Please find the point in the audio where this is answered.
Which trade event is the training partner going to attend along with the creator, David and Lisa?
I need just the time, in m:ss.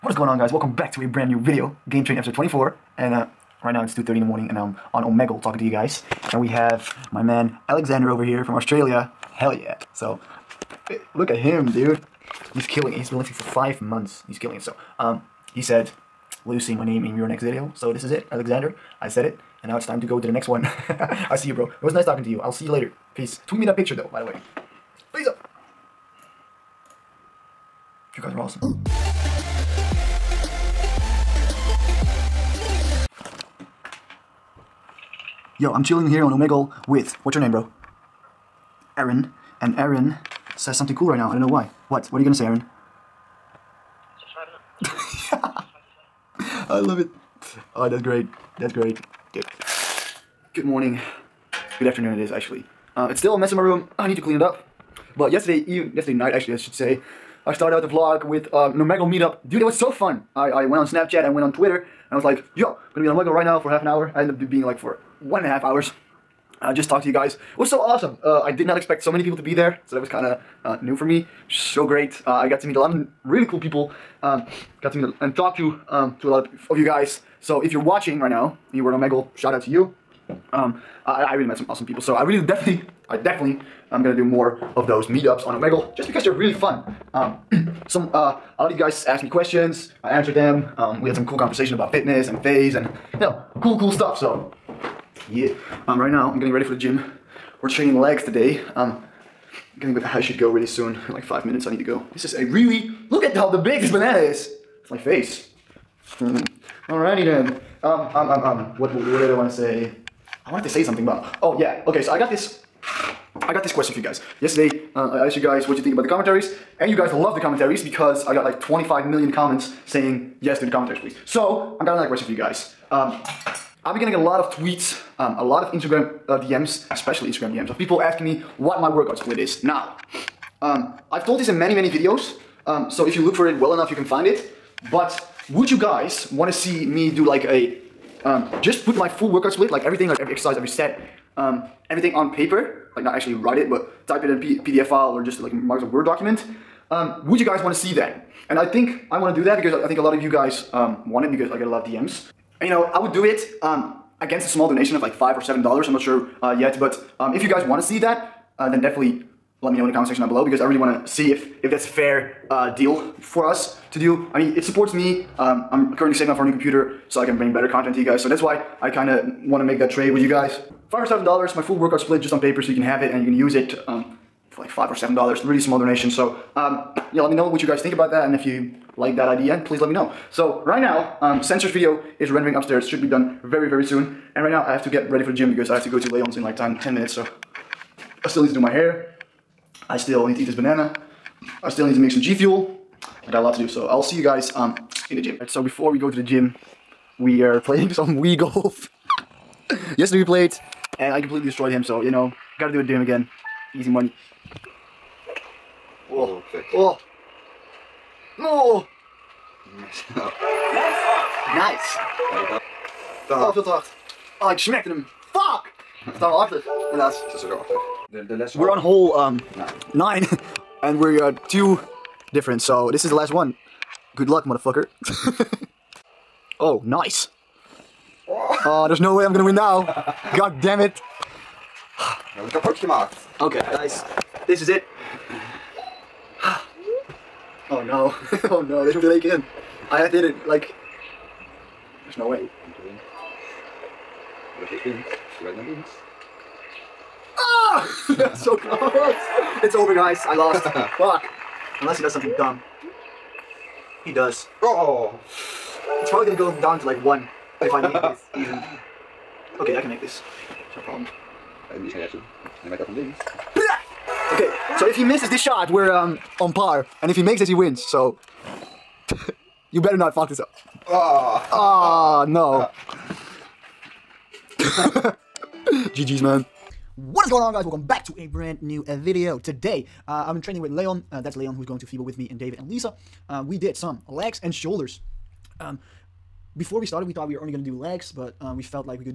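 4:41.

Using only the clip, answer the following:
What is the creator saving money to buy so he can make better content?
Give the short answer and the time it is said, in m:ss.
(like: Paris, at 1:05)
A new computer, at 2:46.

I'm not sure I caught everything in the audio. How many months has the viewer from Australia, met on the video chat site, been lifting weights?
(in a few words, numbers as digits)
5.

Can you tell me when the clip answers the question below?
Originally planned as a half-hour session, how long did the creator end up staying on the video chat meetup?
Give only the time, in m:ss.
1:05.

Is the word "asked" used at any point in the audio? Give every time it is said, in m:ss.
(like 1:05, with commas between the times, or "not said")
1:29, 1:55.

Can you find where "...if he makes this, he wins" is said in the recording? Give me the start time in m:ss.
4:27.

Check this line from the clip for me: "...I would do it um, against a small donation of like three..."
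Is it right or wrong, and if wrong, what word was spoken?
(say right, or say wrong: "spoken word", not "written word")
wrong: "five", not "three".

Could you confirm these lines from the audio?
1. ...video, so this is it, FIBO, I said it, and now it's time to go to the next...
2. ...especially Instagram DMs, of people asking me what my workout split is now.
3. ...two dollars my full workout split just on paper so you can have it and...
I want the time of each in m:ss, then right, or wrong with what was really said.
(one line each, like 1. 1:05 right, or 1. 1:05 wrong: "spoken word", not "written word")
1. 0:17 wrong: "Alexander", not "FIBO"
2. 2:06 right
3. 2:51 wrong: "seven", not "two".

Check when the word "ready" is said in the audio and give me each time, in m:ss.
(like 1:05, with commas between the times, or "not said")
1:36, 3:05.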